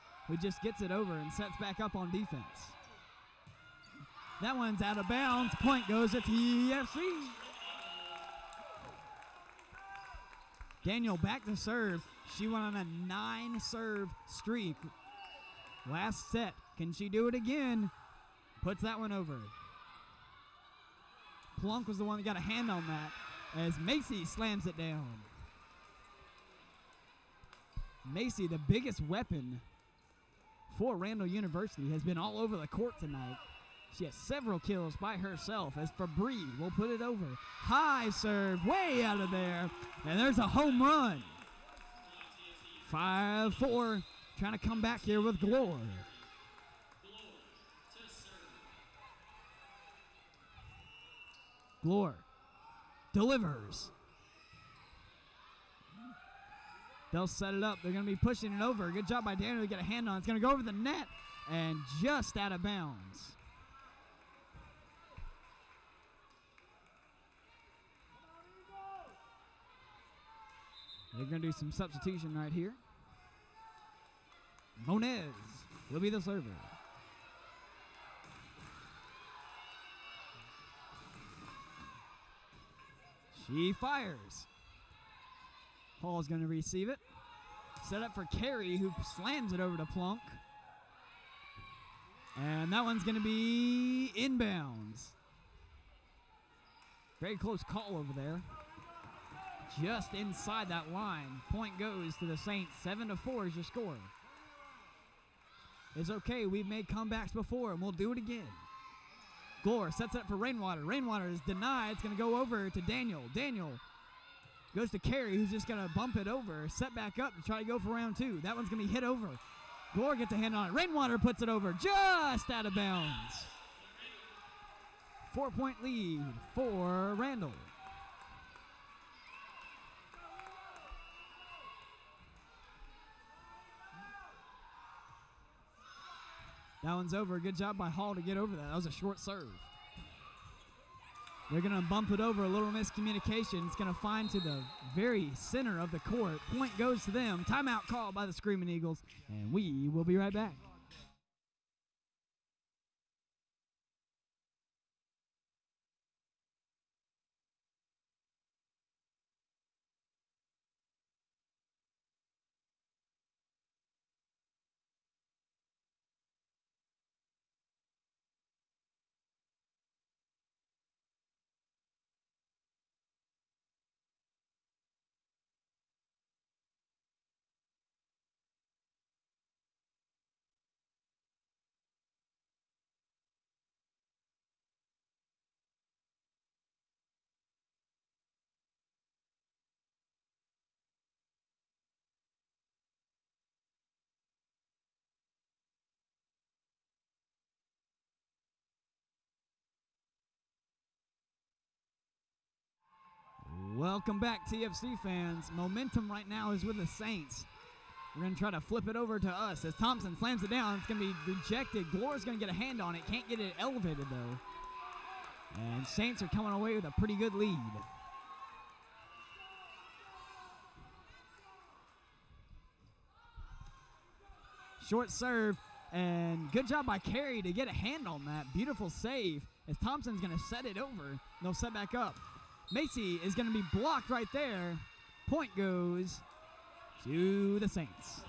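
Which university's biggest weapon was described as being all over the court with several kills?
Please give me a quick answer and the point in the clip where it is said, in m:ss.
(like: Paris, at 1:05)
Randall University, at 0:30.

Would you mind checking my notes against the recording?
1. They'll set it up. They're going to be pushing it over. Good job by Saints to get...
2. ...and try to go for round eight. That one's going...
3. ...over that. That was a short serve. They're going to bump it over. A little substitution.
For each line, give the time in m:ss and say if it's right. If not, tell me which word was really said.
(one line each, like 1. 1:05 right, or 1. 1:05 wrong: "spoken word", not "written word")
1. 0:57 wrong: "Daniel", not "Saints"
2. 1:57 wrong: "two", not "eight"
3. 2:18 wrong: "miscommunication", not "substitution".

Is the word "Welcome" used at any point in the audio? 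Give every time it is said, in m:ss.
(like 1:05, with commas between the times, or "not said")
3:23.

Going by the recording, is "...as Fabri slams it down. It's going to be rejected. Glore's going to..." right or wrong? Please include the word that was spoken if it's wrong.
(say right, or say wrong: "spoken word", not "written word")
wrong: "Thompson", not "Fabri".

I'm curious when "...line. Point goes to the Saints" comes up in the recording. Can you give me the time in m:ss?
1:40.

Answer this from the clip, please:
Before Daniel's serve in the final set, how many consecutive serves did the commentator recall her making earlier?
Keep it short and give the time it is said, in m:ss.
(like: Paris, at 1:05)
9, at 0:13.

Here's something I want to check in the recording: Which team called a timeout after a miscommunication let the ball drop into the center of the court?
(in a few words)
Screaming Eagles.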